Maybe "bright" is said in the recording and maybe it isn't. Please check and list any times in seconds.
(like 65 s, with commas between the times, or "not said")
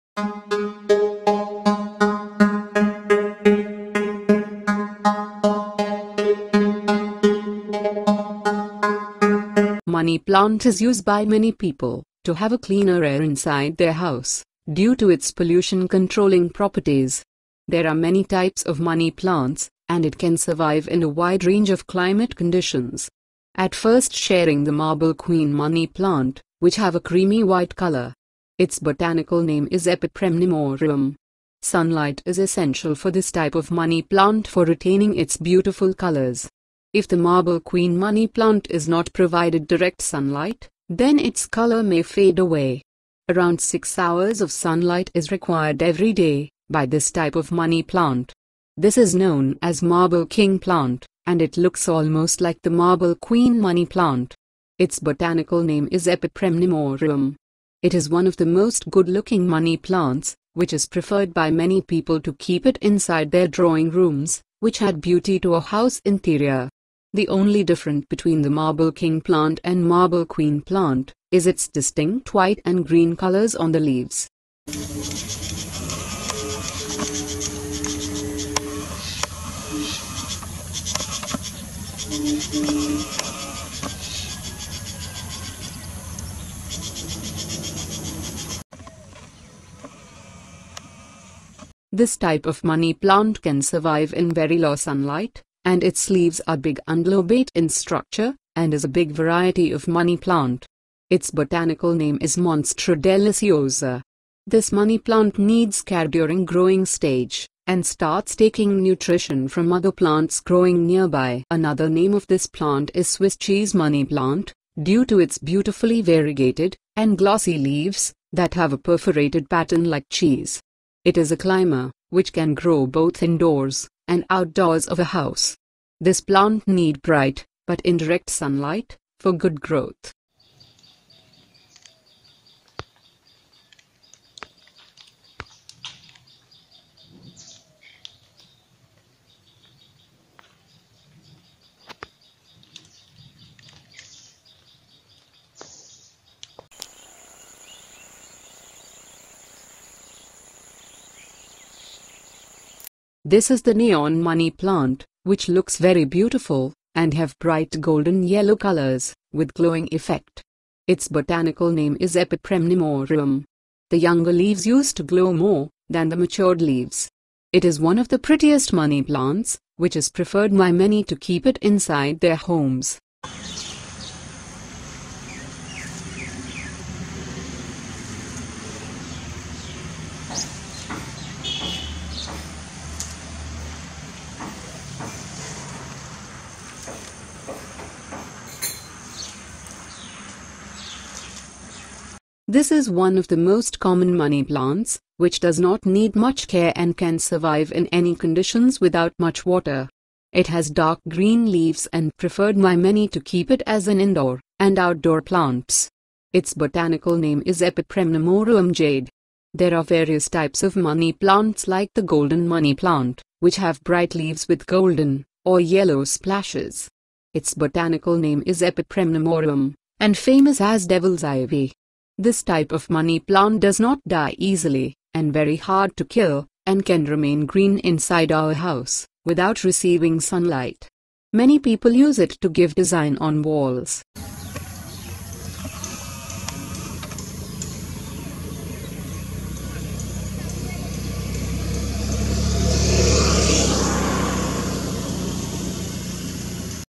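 127 s, 157 s, 213 s.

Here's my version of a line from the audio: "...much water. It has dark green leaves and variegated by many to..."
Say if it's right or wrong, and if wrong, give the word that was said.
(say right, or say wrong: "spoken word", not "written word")
wrong: "preferred", not "variegated".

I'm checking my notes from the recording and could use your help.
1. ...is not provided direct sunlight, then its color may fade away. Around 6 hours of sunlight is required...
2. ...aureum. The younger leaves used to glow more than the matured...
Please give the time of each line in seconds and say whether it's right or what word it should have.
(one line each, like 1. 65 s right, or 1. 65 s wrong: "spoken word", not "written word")
1. 38 s right
2. 162 s right.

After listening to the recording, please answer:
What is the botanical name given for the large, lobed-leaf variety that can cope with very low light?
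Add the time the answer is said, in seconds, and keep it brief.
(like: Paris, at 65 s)
Monstera deliciosa, at 102 s.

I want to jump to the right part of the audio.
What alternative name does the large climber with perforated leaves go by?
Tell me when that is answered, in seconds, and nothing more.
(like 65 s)
113 s.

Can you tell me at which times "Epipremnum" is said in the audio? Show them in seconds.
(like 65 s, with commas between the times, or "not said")
29 s, 56 s, 162 s, 207 s, 218 s.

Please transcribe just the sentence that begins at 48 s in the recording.
This is known as marble king plant, and it looks almost like the marble queen money plant.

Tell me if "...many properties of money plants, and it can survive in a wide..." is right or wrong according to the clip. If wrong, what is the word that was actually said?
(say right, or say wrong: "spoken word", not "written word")
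wrong: "types", not "properties".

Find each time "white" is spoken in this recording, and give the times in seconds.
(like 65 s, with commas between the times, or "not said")
27 s, 72 s.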